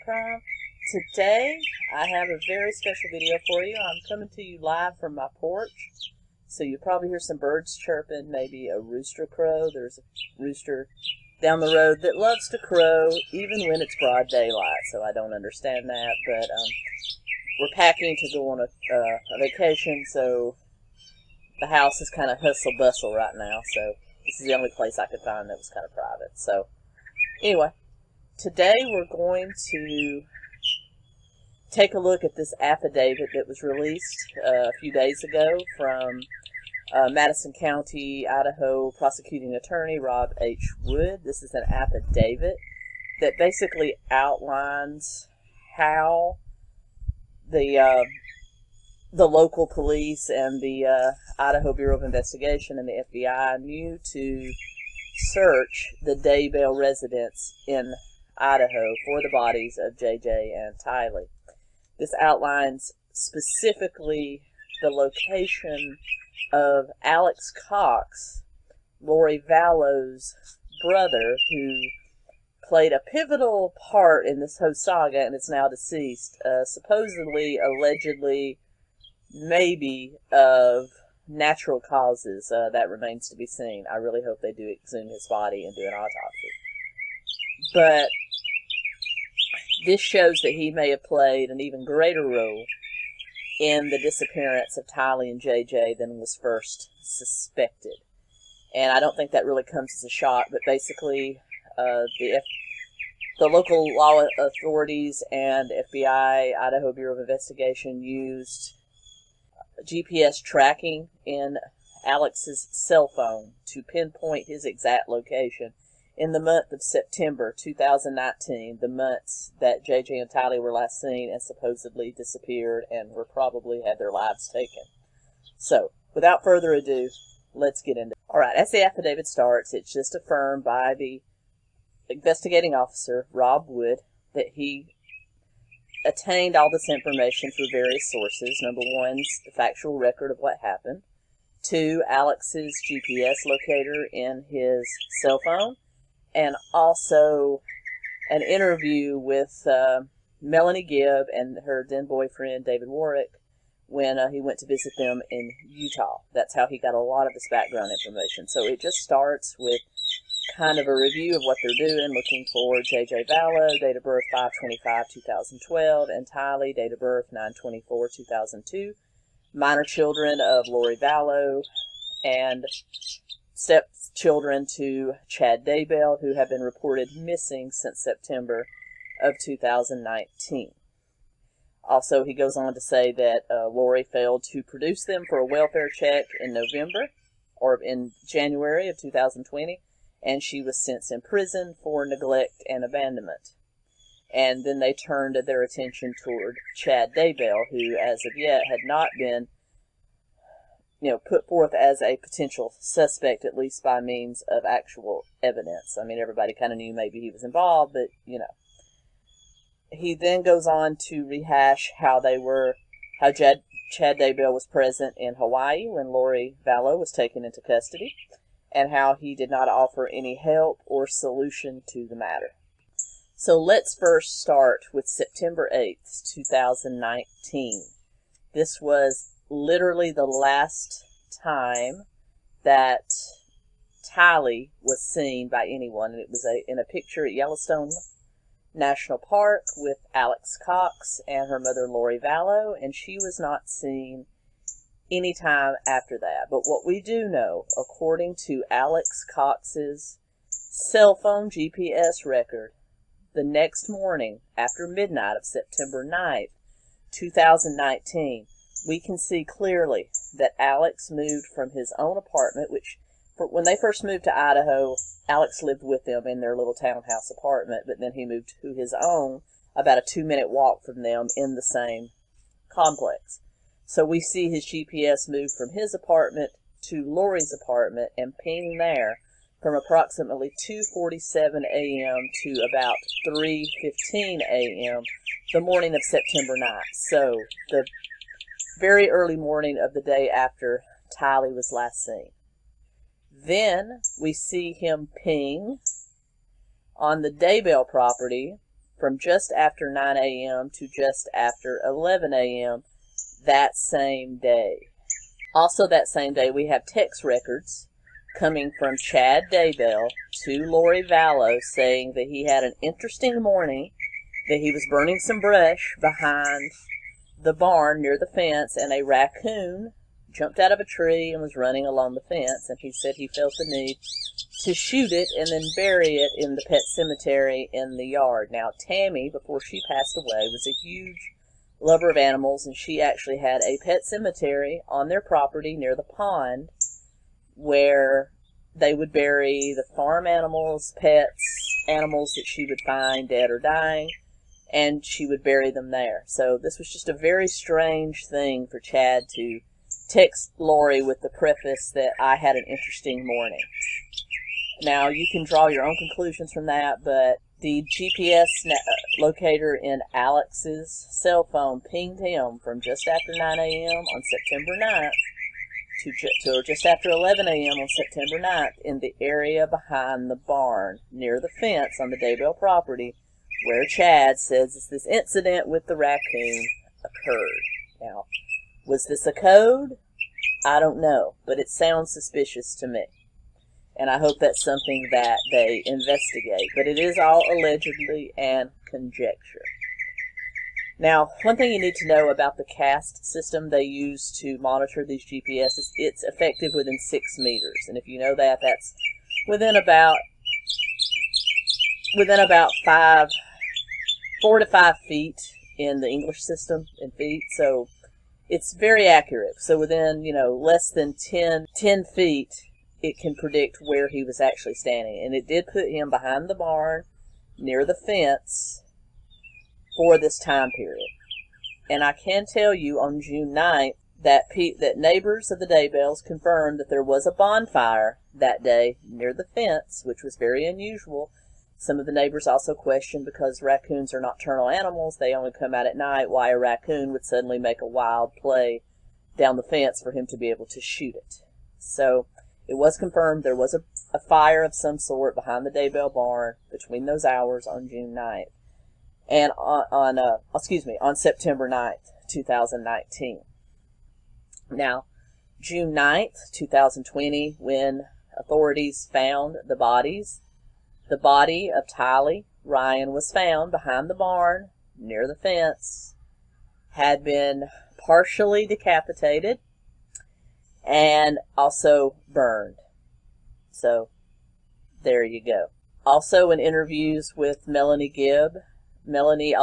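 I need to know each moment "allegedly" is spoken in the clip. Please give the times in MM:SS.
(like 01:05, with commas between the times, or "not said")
01:17, 06:27.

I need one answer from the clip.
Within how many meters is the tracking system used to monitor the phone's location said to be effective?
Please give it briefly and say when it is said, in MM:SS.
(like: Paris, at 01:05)
6, at 06:36.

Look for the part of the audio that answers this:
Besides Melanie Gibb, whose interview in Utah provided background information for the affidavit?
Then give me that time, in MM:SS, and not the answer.
02:32.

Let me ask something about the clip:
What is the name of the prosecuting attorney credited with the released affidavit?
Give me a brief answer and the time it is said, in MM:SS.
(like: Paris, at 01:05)
Rob H. Wood, at 00:39.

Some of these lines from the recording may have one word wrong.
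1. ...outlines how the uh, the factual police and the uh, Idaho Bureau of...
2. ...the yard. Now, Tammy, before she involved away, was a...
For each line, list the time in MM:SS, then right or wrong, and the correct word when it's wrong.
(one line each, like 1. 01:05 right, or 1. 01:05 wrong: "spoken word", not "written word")
1. 00:44 wrong: "local", not "factual"
2. 05:27 wrong: "passed", not "involved".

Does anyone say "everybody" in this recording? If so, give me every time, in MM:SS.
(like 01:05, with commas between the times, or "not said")
03:26.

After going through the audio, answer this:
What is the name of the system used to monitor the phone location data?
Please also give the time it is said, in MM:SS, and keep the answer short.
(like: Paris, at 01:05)
CAST, at 06:32.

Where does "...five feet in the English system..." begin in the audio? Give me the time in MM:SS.
06:44.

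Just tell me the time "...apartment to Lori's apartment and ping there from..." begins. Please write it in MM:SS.
04:35.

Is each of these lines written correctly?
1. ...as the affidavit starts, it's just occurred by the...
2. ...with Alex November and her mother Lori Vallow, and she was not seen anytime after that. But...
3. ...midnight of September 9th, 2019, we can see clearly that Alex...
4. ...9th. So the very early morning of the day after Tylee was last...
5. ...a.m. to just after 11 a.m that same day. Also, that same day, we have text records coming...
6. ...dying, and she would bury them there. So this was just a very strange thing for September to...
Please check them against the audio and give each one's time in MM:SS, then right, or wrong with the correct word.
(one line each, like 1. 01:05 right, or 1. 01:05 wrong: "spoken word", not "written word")
1. 02:08 wrong: "affirmed", not "occurred"
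2. 03:59 wrong: "Cox", not "November"
3. 04:14 right
4. 04:46 right
5. 05:00 right
6. 05:43 wrong: "Chad", not "September".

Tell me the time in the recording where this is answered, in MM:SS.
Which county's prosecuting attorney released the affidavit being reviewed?
00:37.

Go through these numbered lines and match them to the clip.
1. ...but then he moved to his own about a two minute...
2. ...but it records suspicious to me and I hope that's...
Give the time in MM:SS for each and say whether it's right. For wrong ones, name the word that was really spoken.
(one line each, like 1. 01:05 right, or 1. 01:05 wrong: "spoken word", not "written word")
1. 04:27 right
2. 06:21 wrong: "sounds", not "records".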